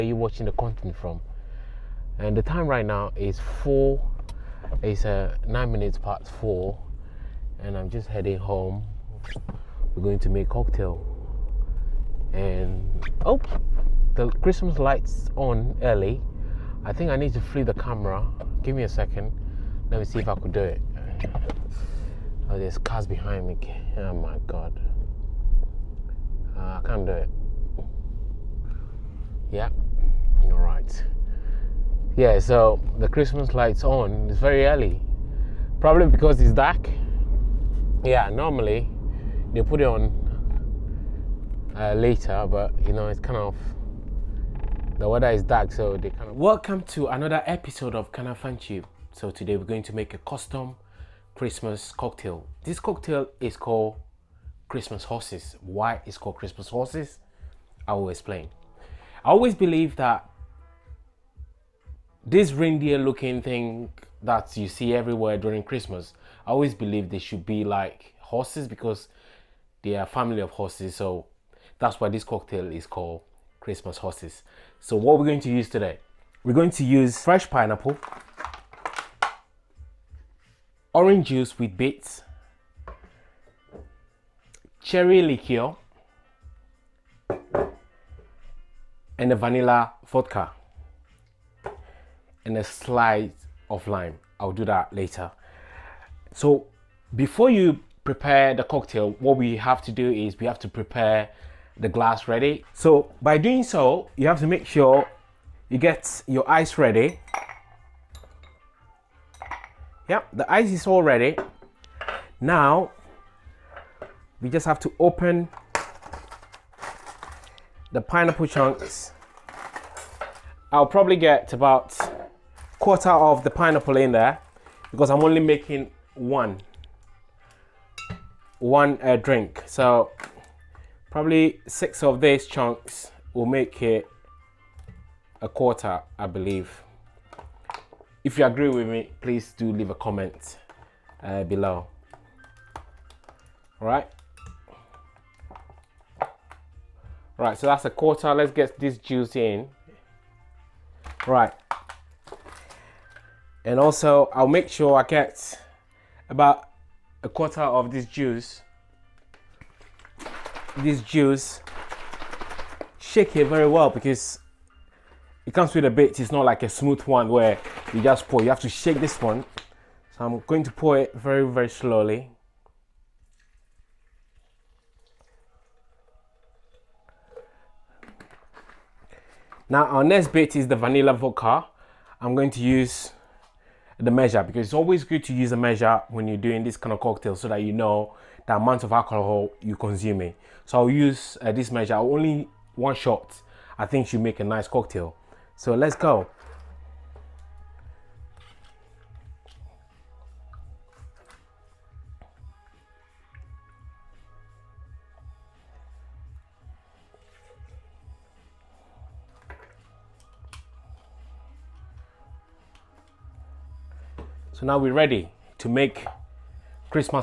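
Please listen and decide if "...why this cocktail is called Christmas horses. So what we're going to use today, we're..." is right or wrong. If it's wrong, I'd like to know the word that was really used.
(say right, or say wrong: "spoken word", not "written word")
right.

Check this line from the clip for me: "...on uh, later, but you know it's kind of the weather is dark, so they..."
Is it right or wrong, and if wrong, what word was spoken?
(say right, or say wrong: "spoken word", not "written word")
right.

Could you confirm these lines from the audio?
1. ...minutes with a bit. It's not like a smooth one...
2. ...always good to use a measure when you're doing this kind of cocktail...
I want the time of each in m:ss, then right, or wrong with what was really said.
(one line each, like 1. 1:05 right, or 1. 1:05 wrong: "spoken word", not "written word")
1. 2:45 wrong: "comes", not "minutes"
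2. 3:04 right.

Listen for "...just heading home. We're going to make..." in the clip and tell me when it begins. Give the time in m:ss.
0:07.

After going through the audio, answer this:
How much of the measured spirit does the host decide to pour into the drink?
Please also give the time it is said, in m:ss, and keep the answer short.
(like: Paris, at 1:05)
1 shot, at 3:12.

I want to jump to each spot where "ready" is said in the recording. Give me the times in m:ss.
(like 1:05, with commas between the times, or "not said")
1:42, 1:46, 1:51, 3:34.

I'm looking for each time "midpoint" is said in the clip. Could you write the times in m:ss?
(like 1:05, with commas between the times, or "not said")
not said.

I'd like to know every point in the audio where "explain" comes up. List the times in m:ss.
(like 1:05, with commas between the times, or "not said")
0:58.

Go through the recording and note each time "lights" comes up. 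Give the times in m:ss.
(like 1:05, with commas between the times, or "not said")
0:14, 0:33.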